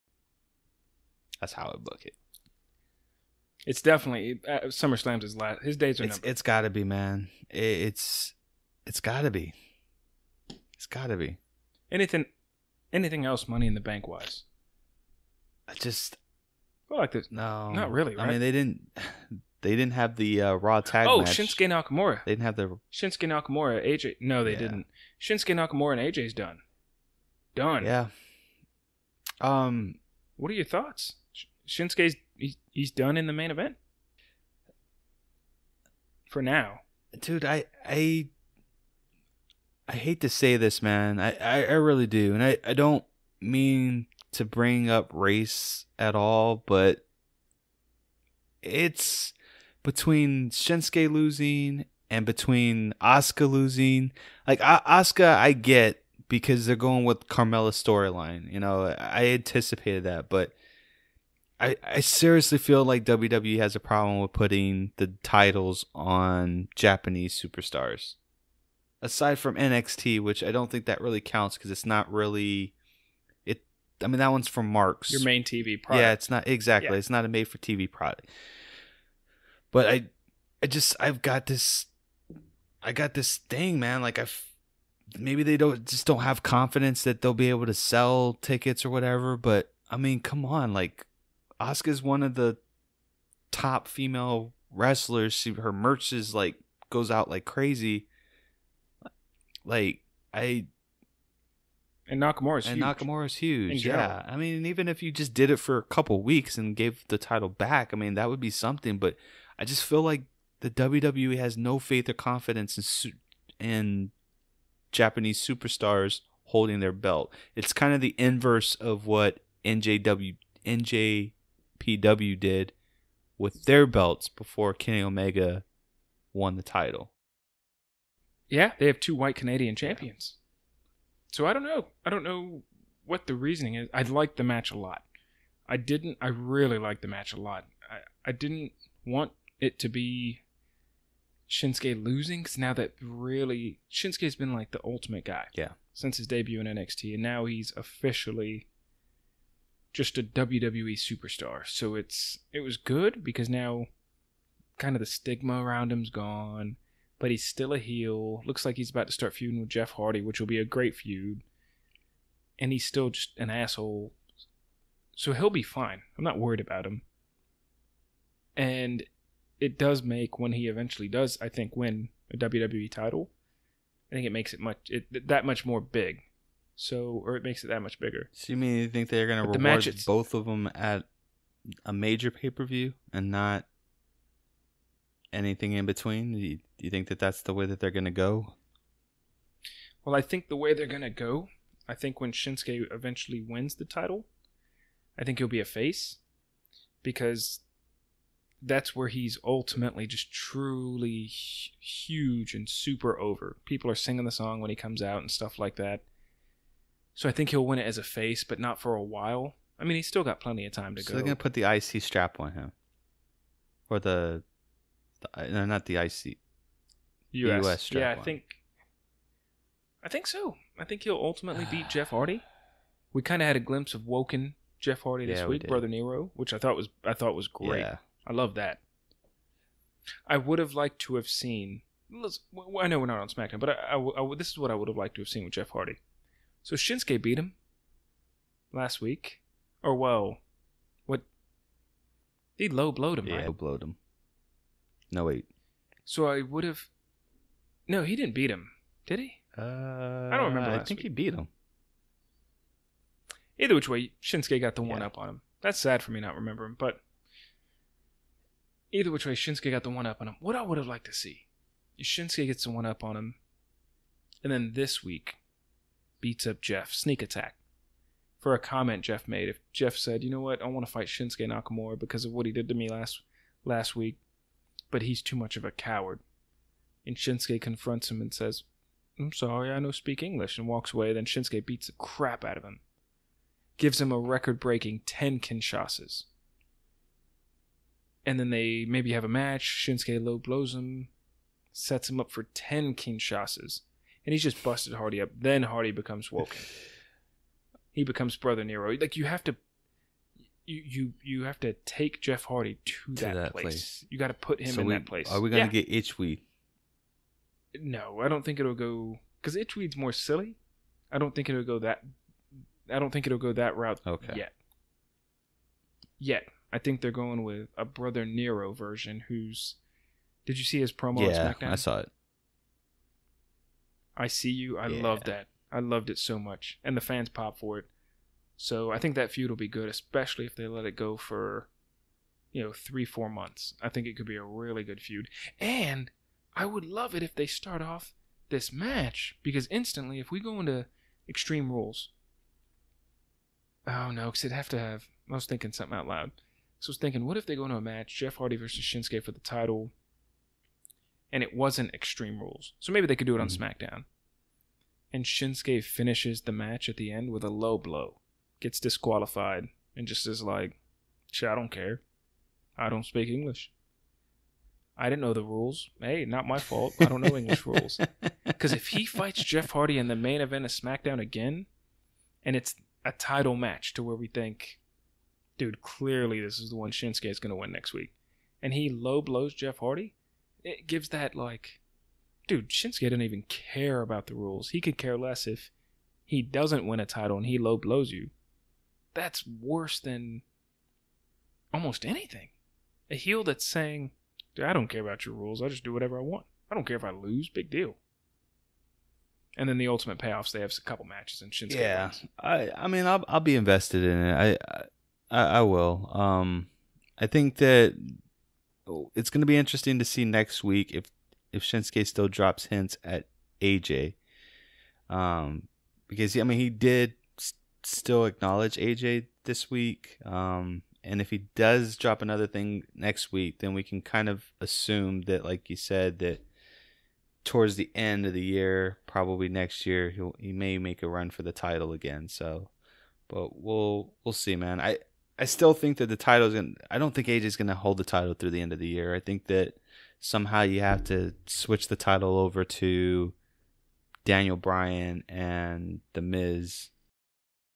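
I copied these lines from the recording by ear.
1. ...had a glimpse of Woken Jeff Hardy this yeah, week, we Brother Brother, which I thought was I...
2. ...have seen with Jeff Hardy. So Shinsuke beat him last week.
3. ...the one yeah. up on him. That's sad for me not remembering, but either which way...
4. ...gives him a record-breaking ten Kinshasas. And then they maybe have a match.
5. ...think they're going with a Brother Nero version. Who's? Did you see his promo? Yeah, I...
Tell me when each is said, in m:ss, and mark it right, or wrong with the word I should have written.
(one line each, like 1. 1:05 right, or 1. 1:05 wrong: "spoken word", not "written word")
1. 3:43 wrong: "Nero", not "Brother"
2. 3:55 right
3. 4:14 right
4. 4:43 right
5. 5:16 right.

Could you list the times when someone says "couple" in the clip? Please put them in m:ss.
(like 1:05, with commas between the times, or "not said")
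1:45, 6:40.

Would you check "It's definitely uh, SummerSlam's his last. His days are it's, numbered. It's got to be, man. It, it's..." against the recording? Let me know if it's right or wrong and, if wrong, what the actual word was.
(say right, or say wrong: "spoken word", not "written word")
right.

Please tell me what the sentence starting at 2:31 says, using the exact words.
So it's it was good because now kind of the stigma around him's gone, but he's still a heel.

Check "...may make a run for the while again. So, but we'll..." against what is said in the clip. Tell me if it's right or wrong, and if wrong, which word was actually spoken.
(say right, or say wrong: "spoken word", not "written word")
wrong: "title", not "while".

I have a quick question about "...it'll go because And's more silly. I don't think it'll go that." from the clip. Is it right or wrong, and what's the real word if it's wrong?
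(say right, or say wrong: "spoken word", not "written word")
wrong: "Itchweed", not "And".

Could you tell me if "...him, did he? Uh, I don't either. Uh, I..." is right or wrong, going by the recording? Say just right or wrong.
wrong.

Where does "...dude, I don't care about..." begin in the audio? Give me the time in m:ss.
6:34.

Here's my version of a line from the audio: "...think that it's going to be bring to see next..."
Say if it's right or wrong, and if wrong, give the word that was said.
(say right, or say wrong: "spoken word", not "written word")
wrong: "interesting", not "bring".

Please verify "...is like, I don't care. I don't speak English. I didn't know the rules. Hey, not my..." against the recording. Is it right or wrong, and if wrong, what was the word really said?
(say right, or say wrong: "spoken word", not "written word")
right.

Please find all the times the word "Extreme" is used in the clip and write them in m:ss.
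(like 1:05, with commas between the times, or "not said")
5:41, 5:51.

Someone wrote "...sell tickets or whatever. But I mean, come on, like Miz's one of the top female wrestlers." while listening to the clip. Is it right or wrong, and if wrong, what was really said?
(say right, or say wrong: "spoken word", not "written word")
wrong: "Asuka", not "Miz".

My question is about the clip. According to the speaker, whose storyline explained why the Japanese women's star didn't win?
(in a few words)
Carmella.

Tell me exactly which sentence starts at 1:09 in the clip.
Aside from NXT, which I don't think that really counts because it's not really it.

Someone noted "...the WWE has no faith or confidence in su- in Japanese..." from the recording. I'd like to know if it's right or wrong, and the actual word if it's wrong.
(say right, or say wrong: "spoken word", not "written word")
right.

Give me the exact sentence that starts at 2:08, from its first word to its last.
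Yeah, they have two white Canadian champions.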